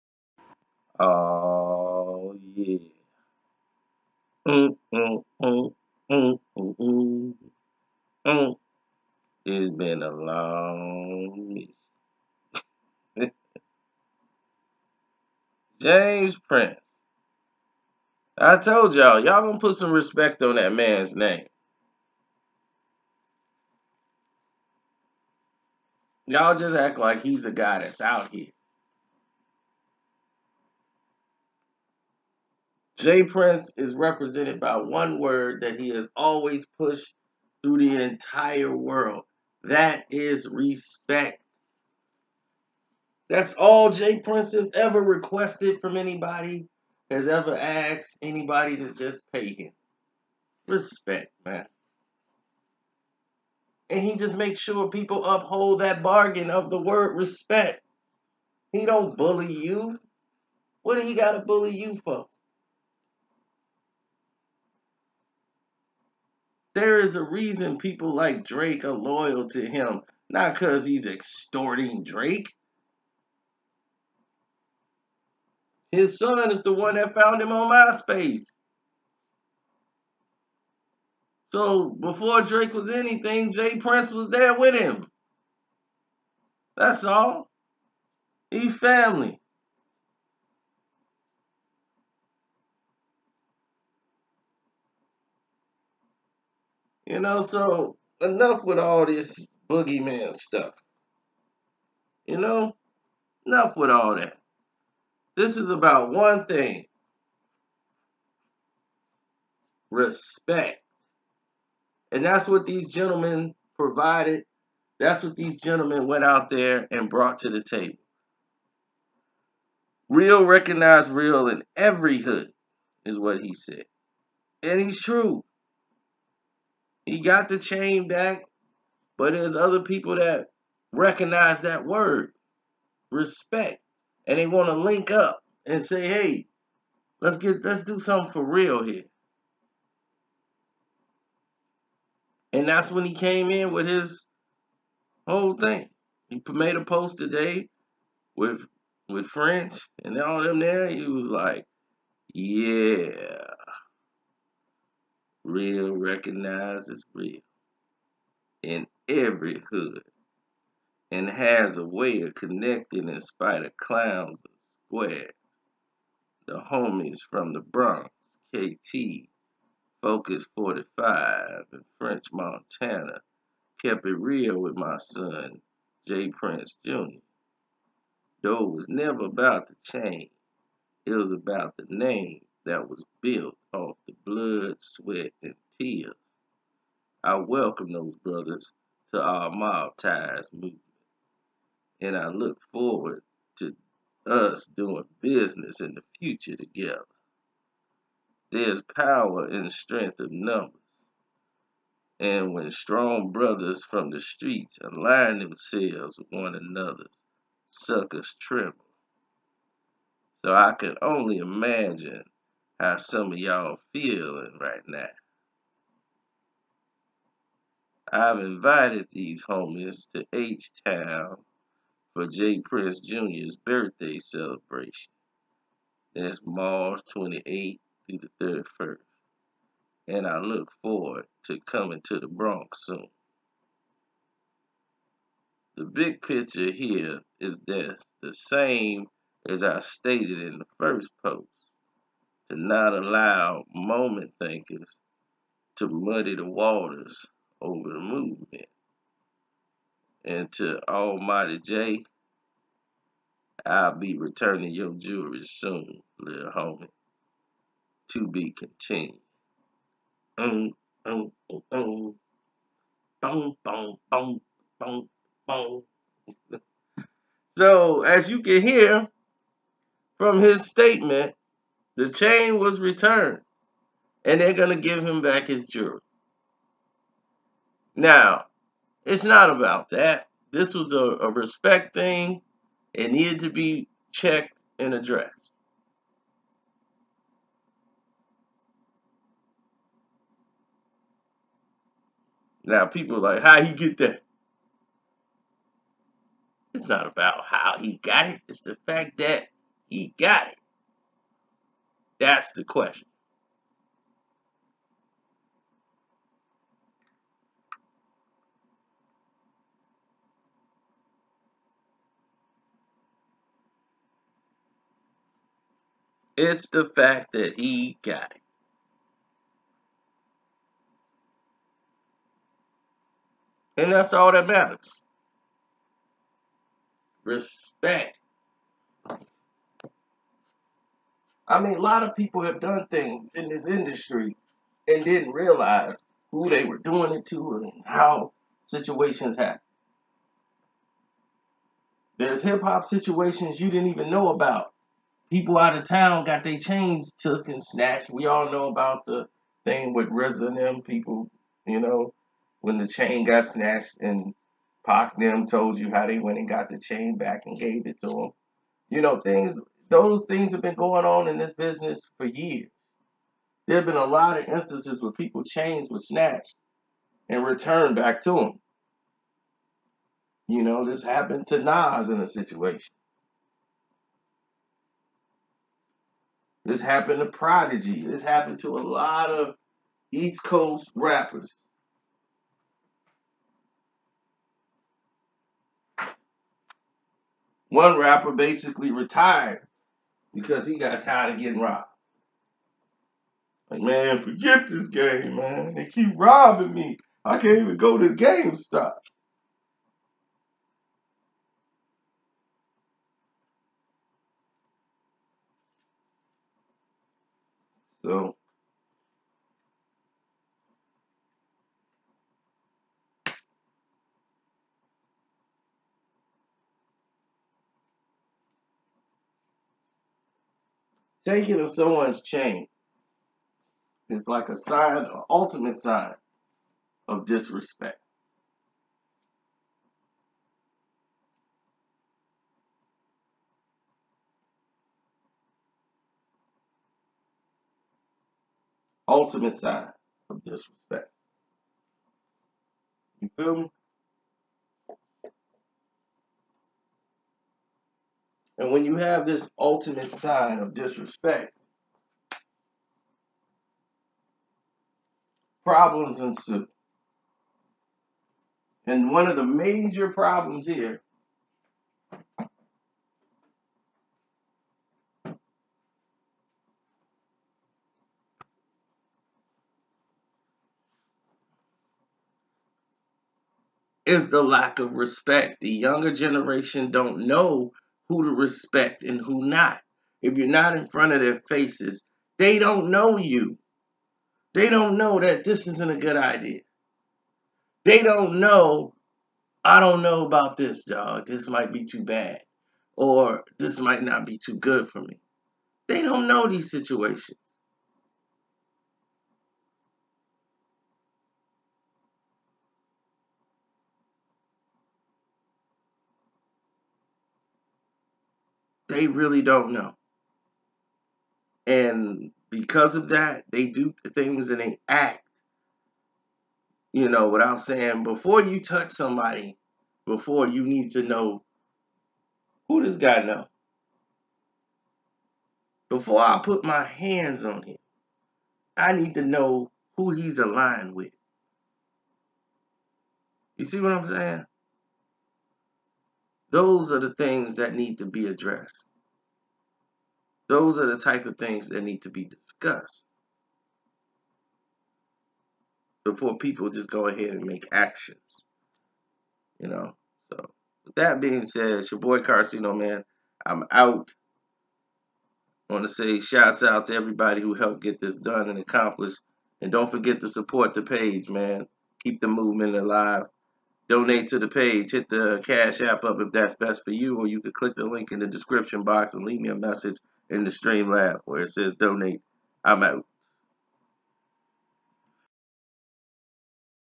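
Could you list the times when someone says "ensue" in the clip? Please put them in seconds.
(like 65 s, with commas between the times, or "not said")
456 s.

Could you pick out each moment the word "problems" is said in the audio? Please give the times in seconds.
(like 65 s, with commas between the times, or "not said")
455 s, 460 s.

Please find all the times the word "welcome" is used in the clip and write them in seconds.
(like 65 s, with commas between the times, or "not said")
187 s.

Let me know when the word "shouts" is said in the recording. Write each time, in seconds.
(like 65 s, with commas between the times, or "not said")
556 s.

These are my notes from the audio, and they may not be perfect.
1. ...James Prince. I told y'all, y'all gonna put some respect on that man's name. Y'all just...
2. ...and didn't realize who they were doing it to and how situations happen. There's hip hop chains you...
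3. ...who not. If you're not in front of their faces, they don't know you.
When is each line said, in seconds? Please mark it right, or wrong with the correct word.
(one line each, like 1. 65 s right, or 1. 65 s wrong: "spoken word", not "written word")
1. 15 s right
2. 334 s wrong: "situations", not "chains"
3. 479 s right.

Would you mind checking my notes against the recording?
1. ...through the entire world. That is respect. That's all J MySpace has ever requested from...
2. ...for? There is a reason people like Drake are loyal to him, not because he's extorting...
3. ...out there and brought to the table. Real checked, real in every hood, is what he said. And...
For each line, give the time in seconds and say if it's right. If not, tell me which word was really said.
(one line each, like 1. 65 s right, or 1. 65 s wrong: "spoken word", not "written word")
1. 37 s wrong: "Prince", not "MySpace"
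2. 62 s right
3. 116 s wrong: "recognized", not "checked".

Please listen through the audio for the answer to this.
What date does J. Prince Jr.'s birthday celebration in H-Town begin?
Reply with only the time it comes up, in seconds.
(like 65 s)
226 s.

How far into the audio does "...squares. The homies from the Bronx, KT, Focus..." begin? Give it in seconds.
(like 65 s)
164 s.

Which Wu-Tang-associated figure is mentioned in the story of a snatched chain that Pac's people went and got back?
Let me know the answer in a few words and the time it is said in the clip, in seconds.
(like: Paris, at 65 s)
RZA, at 350 s.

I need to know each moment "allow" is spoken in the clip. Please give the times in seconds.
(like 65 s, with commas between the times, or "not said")
242 s.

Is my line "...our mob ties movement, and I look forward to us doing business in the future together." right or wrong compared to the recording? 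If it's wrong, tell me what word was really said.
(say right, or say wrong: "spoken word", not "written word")
right.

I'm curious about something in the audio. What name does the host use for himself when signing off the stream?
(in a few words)
Karceno.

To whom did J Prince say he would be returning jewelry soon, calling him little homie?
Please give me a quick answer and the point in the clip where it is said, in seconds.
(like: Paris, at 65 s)
Almighty Jay, at 250 s.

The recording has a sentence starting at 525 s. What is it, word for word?
Before I put my hands on him, I need to know who he's aligned with.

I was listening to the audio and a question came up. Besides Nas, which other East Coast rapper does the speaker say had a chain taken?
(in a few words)
Prodigy.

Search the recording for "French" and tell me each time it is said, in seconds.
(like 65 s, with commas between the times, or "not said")
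149 s, 171 s.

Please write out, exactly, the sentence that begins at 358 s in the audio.
You know, things those things have been going on in this business for years.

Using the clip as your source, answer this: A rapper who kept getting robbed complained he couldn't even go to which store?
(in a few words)
GameStop.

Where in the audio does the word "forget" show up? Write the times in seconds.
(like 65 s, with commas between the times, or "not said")
394 s, 559 s.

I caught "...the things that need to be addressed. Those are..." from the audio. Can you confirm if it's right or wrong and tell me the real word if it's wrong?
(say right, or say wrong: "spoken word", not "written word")
right.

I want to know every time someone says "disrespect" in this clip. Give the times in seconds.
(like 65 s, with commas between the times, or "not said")
427 s, 440 s, 450 s.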